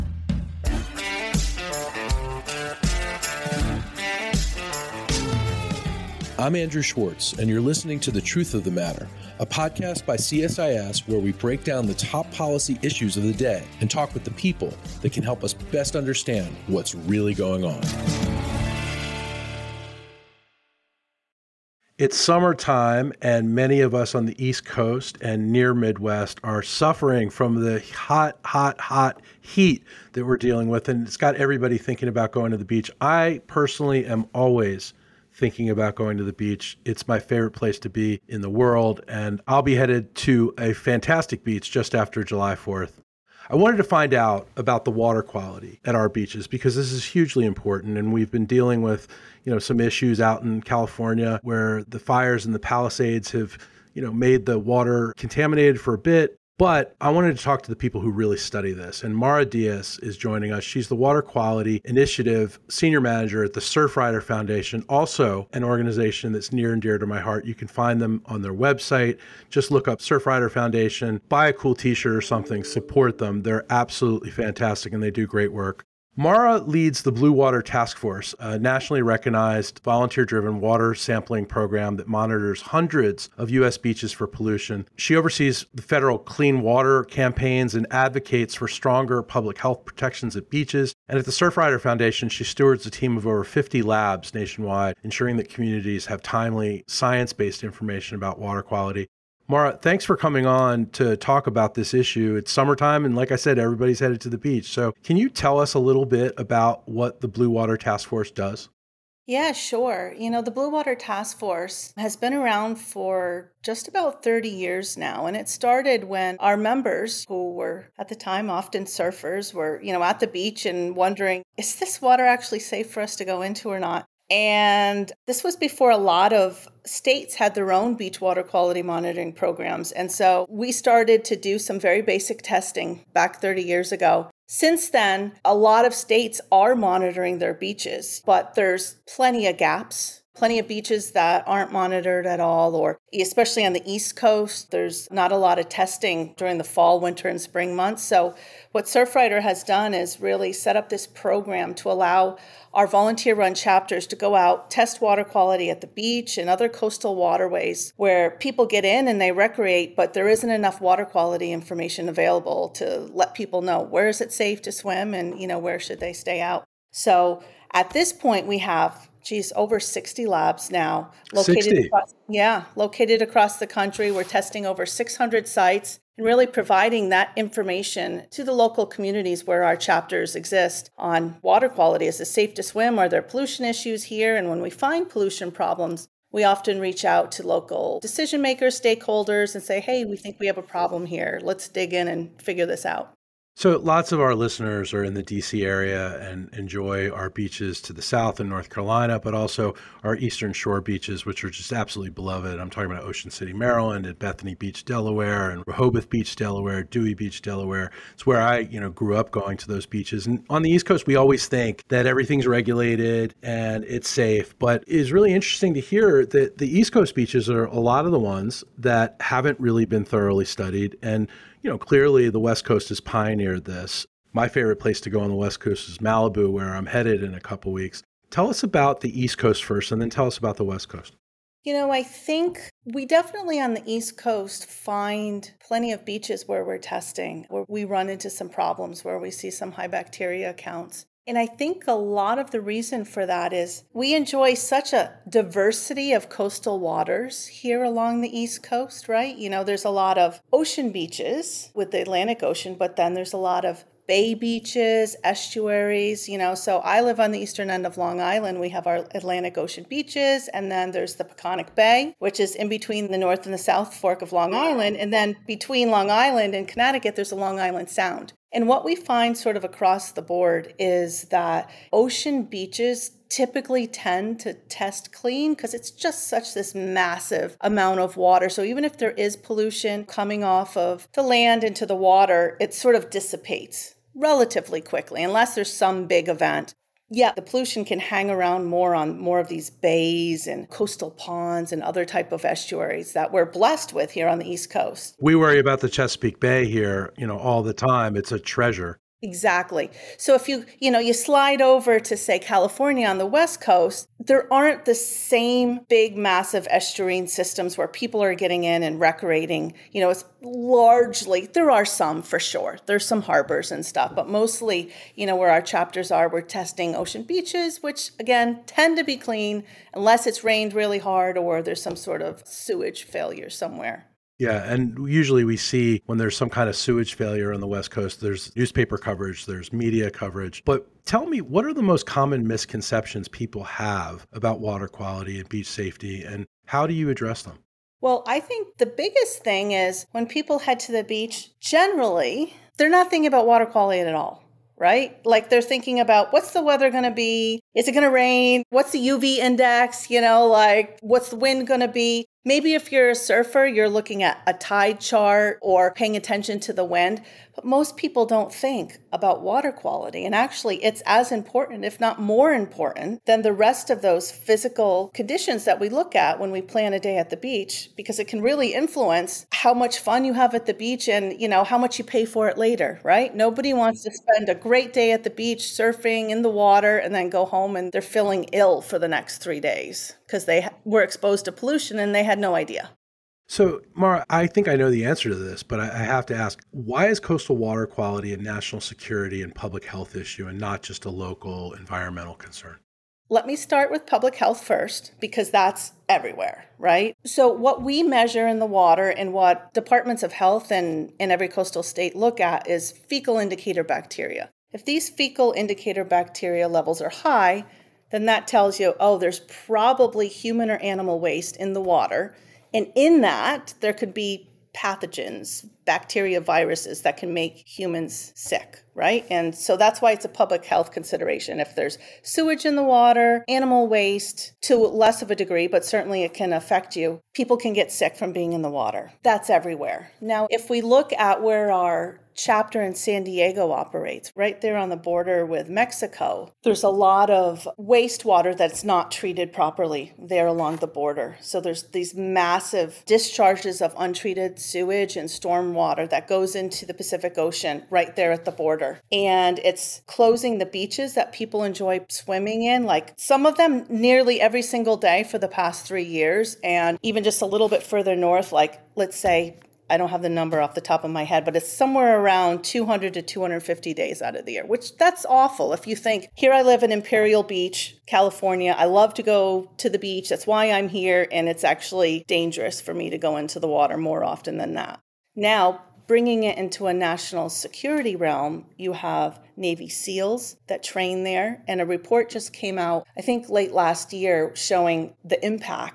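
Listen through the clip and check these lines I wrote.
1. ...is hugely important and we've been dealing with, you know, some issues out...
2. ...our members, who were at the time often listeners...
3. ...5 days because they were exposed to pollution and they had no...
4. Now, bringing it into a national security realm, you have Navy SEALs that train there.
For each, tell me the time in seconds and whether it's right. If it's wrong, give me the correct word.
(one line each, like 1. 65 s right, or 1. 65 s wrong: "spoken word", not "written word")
1. 46 s right
2. 116 s wrong: "surfers", not "listeners"
3. 379 s wrong: "3", not "5"
4. 475 s right.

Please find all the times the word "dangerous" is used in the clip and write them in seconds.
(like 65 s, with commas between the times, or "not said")
472 s.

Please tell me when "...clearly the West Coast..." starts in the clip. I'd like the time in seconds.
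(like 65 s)
221 s.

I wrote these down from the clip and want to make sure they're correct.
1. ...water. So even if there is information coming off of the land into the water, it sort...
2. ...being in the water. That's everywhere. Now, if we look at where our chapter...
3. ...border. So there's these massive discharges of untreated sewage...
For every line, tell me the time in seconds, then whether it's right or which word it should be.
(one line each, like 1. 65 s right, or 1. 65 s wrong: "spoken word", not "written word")
1. 278 s wrong: "pollution", not "information"
2. 428 s right
3. 440 s right.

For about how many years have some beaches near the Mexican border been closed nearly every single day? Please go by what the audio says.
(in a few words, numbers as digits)
3 years.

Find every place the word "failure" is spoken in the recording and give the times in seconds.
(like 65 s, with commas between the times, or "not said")
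323 s, 327 s.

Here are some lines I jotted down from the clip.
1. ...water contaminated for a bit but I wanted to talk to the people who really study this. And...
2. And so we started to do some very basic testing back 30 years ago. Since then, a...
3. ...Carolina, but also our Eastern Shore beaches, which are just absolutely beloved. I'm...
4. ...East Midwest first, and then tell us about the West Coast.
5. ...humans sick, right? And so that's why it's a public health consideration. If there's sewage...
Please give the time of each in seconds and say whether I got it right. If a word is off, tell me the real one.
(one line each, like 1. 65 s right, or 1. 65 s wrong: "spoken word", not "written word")
1. 54 s right
2. 129 s right
3. 198 s right
4. 229 s wrong: "Coast", not "Midwest"
5. 417 s right.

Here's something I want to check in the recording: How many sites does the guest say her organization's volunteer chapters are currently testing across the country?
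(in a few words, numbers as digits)
over 600.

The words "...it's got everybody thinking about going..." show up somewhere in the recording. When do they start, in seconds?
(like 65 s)
31 s.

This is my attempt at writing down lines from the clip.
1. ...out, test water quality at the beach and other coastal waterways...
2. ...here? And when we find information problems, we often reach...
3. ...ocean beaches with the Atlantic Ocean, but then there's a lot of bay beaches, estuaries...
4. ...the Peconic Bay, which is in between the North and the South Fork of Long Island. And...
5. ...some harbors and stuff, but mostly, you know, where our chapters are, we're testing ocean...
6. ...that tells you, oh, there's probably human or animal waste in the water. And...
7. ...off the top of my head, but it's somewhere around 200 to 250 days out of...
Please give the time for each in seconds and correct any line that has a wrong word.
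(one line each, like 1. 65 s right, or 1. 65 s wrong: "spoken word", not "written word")
1. 154 s right
2. 184 s wrong: "pollution", not "information"
3. 250 s right
4. 261 s right
5. 313 s right
6. 408 s right
7. 460 s right.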